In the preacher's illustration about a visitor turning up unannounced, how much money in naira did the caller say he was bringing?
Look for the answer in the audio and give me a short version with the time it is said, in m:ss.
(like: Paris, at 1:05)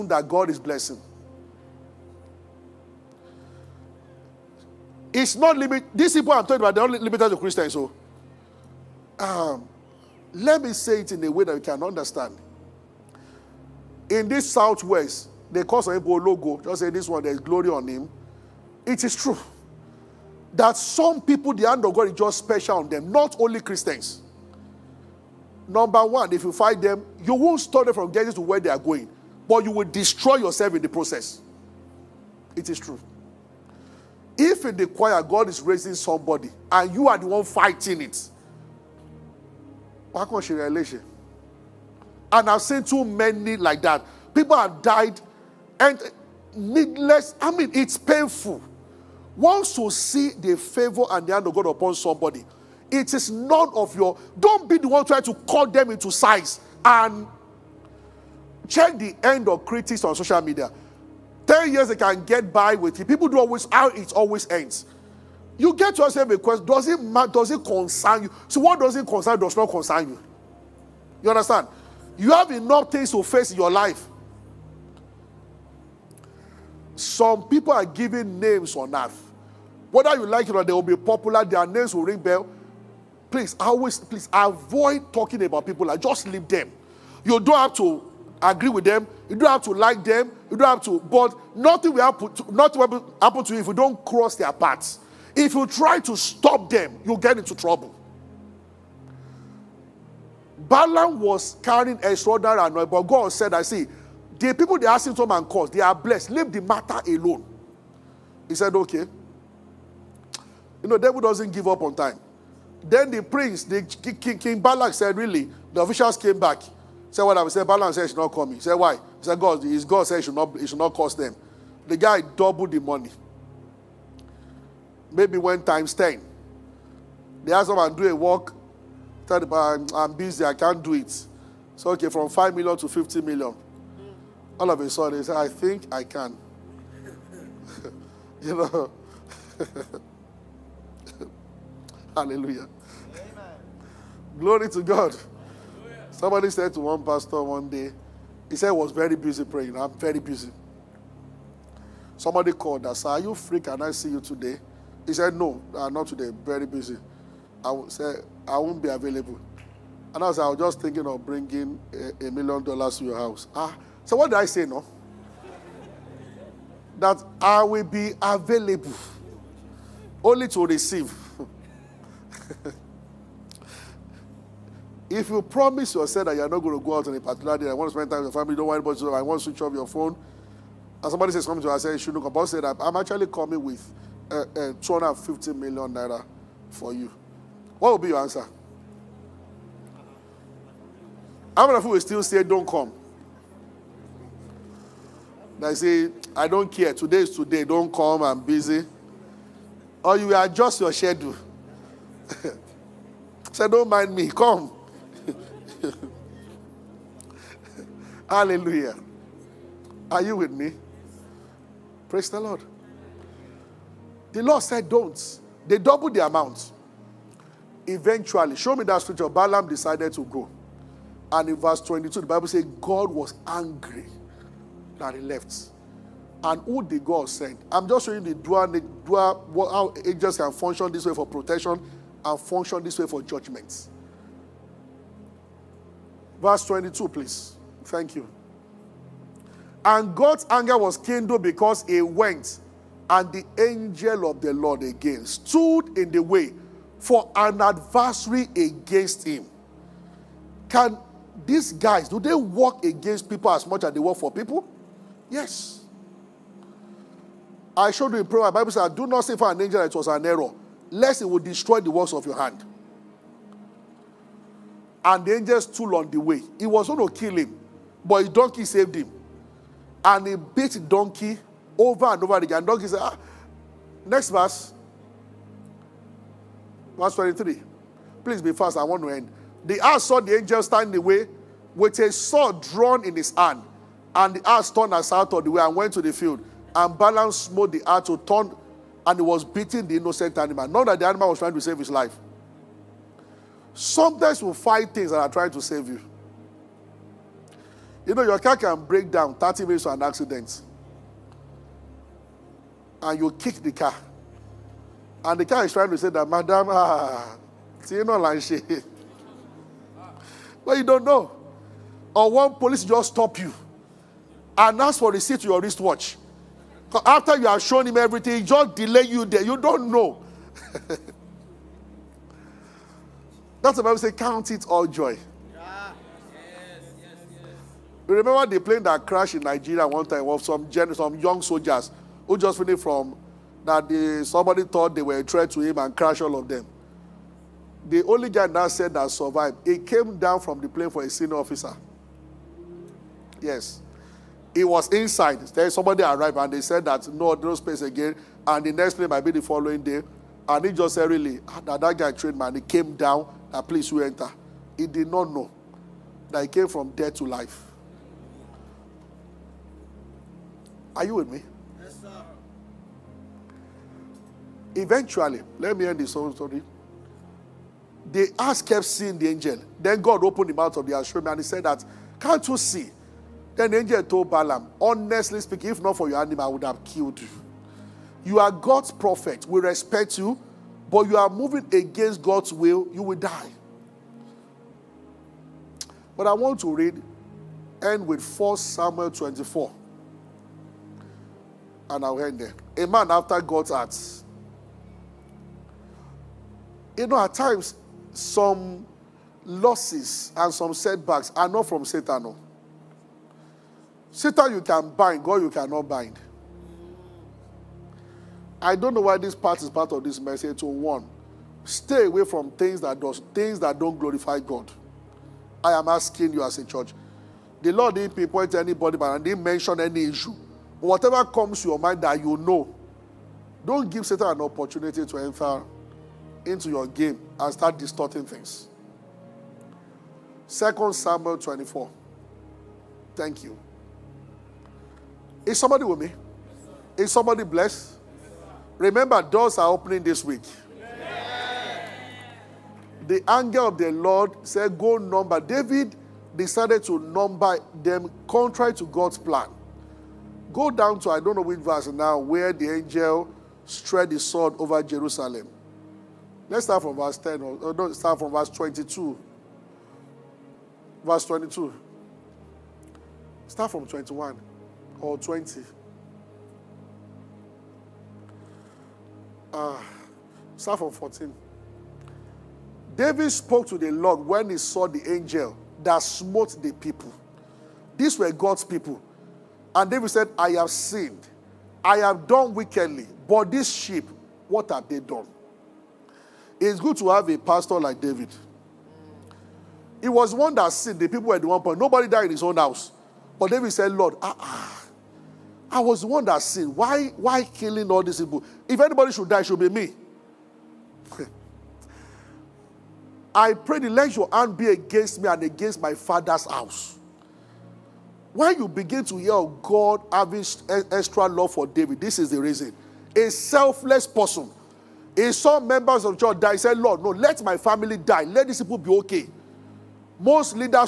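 250 million naira, at 3:04.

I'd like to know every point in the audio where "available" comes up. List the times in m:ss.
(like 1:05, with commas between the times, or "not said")
2:38, 2:48.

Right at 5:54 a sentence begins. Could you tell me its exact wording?
He did not know that he came from death to life.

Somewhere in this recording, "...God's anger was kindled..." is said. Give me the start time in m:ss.
4:00.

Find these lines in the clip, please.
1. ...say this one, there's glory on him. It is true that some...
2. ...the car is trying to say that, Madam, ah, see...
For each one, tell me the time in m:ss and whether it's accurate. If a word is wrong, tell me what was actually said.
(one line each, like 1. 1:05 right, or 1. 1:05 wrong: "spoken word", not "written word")
1. 0:16 right
2. 5:05 right.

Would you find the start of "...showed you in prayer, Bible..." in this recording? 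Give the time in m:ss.
4:17.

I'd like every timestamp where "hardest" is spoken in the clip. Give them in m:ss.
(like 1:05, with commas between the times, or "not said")
not said.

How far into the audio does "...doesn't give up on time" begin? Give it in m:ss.
1:51.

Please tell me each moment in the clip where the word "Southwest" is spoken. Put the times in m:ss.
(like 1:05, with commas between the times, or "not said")
0:14.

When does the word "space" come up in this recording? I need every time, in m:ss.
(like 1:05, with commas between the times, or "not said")
5:47.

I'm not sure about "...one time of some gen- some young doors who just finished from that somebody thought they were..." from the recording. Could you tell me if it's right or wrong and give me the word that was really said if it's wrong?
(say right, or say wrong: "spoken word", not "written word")
wrong: "soldiers", not "doors".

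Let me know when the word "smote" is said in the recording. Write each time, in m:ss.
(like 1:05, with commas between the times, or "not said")
4:47, 7:56.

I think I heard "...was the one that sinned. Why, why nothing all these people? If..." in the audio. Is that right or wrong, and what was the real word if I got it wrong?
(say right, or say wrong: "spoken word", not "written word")
wrong: "killing", not "nothing".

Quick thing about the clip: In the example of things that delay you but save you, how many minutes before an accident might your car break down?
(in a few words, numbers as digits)
30.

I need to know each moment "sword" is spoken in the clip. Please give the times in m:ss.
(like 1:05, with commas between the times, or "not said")
4:42, 7:34.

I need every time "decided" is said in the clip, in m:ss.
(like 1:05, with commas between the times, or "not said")
3:39, 7:26.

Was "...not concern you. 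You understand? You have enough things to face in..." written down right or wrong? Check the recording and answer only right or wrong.
right.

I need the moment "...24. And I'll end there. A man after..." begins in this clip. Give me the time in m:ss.
6:29.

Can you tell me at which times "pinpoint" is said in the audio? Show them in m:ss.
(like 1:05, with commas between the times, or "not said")
6:58.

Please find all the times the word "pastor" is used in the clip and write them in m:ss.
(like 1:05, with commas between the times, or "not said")
2:27, 8:07.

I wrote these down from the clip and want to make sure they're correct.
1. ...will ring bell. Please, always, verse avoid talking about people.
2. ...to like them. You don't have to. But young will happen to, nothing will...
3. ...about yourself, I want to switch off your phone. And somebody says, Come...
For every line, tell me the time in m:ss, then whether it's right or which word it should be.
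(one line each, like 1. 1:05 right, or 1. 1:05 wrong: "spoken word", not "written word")
1. 1:21 wrong: "please", not "verse"
2. 1:29 wrong: "nothing", not "young"
3. 2:58 right.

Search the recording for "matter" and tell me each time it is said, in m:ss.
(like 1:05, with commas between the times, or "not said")
1:06, 1:46.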